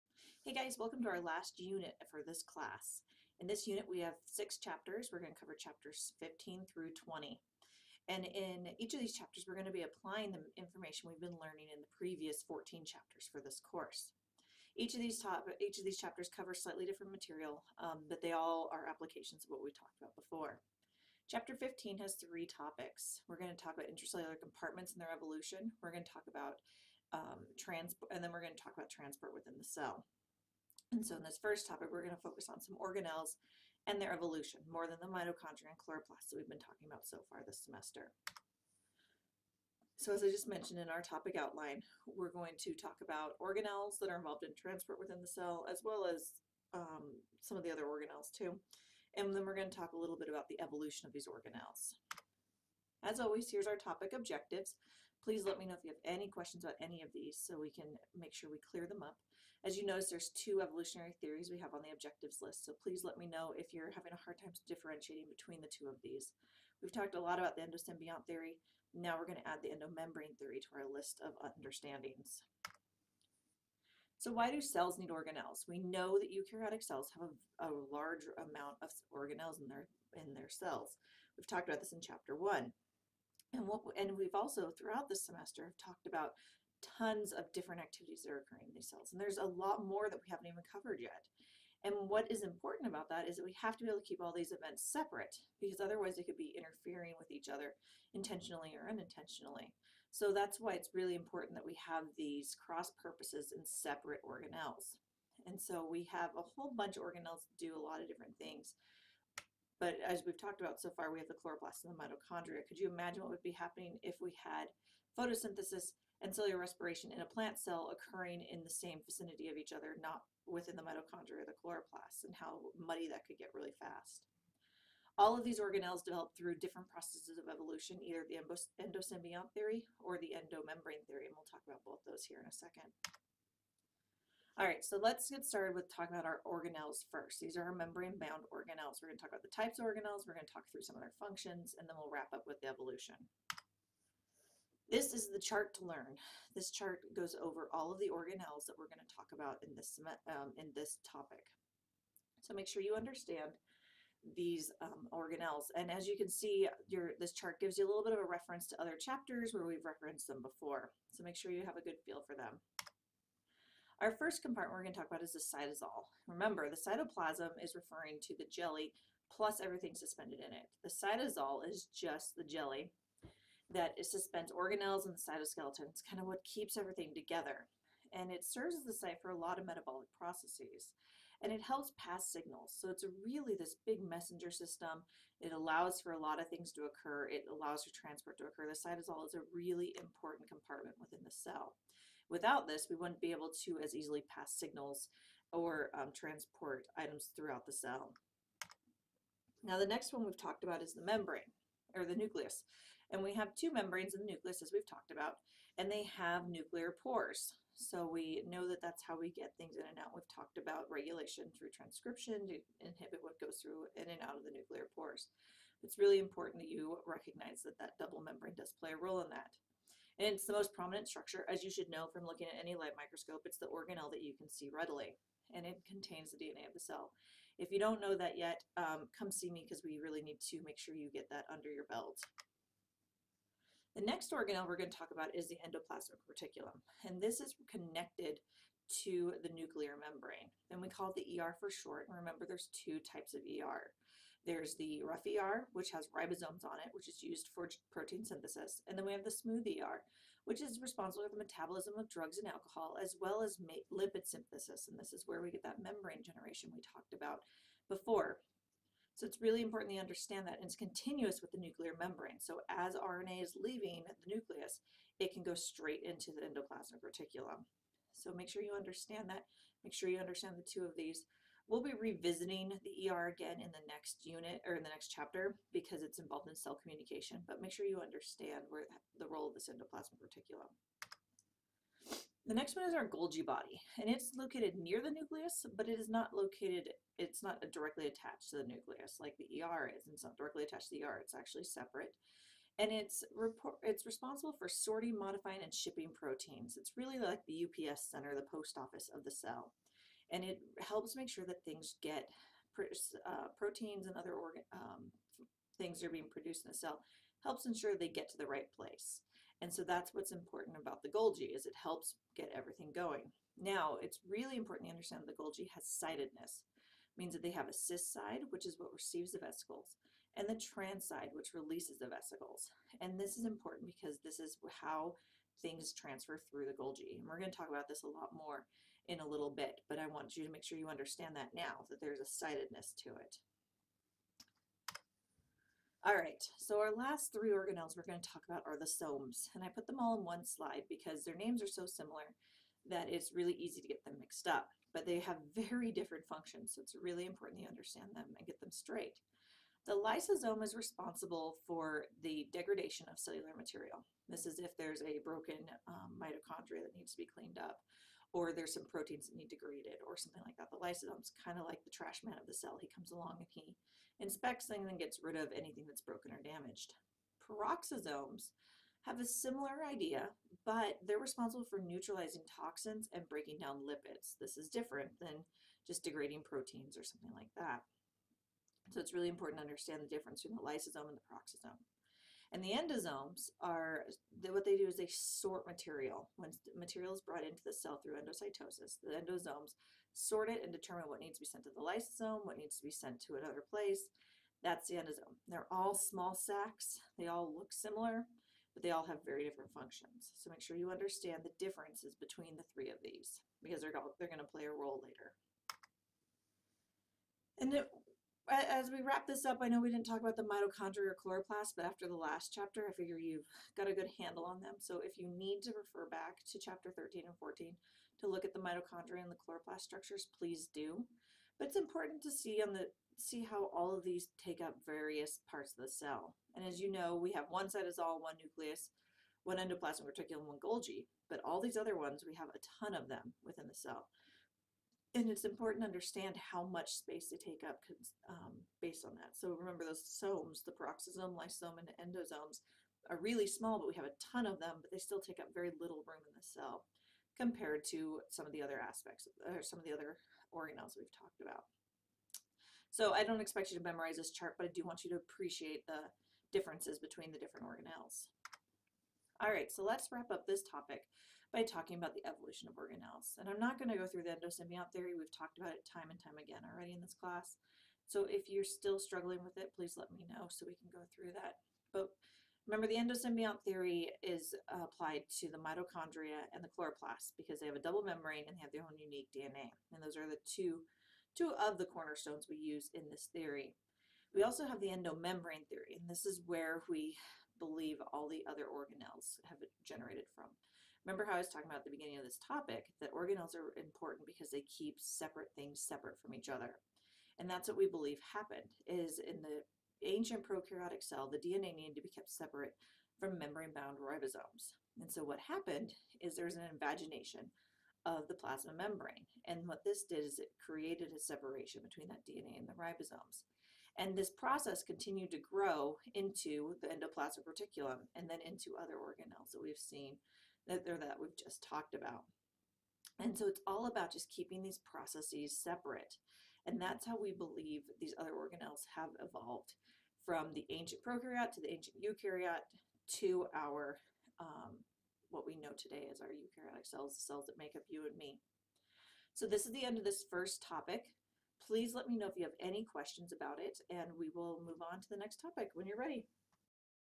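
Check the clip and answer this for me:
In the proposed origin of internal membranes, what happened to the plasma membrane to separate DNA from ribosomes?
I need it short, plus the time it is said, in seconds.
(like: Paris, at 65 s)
an invagination, at 506 s.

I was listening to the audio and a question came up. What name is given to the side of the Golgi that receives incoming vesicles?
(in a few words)
cis side.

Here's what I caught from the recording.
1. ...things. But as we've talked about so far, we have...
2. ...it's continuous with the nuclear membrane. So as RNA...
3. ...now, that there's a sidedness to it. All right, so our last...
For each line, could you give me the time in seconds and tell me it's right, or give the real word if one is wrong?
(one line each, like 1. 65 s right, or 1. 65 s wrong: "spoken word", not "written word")
1. 108 s right
2. 260 s right
3. 331 s right.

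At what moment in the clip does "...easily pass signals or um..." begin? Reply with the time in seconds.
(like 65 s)
193 s.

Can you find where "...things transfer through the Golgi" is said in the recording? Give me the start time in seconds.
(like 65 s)
325 s.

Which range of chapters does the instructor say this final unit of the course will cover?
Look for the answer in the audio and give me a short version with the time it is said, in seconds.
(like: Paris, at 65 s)
15 through 20, at 5 s.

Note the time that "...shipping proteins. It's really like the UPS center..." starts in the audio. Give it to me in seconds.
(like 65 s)
295 s.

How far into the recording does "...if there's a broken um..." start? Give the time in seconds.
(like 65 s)
354 s.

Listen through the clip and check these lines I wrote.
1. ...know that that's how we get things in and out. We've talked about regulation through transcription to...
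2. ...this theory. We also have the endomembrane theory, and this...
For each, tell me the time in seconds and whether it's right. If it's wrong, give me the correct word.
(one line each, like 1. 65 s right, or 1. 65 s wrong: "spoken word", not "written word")
1. 208 s right
2. 483 s right.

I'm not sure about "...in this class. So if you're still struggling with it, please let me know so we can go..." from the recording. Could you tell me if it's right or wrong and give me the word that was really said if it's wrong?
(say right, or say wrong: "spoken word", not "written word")
right.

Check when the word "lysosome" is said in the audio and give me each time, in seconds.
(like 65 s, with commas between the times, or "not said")
349 s, 360 s, 380 s, 391 s, 441 s.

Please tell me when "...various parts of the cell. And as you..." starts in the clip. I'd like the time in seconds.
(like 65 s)
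424 s.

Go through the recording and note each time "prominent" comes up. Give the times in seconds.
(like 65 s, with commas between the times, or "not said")
220 s.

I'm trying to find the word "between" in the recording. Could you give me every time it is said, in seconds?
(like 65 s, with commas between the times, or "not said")
65 s, 380 s, 402 s, 456 s, 511 s.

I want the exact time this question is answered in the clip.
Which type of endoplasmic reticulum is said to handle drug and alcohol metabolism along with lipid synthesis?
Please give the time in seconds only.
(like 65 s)
249 s.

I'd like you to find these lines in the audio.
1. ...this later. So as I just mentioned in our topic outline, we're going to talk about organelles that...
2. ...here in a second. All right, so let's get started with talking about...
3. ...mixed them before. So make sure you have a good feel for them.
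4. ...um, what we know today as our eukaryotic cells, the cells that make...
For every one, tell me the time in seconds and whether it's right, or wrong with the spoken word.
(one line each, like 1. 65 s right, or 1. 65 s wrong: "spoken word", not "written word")
1. 37 s wrong: "semester", not "later"
2. 132 s right
3. 159 s wrong: "referenced", not "mixed"
4. 534 s right.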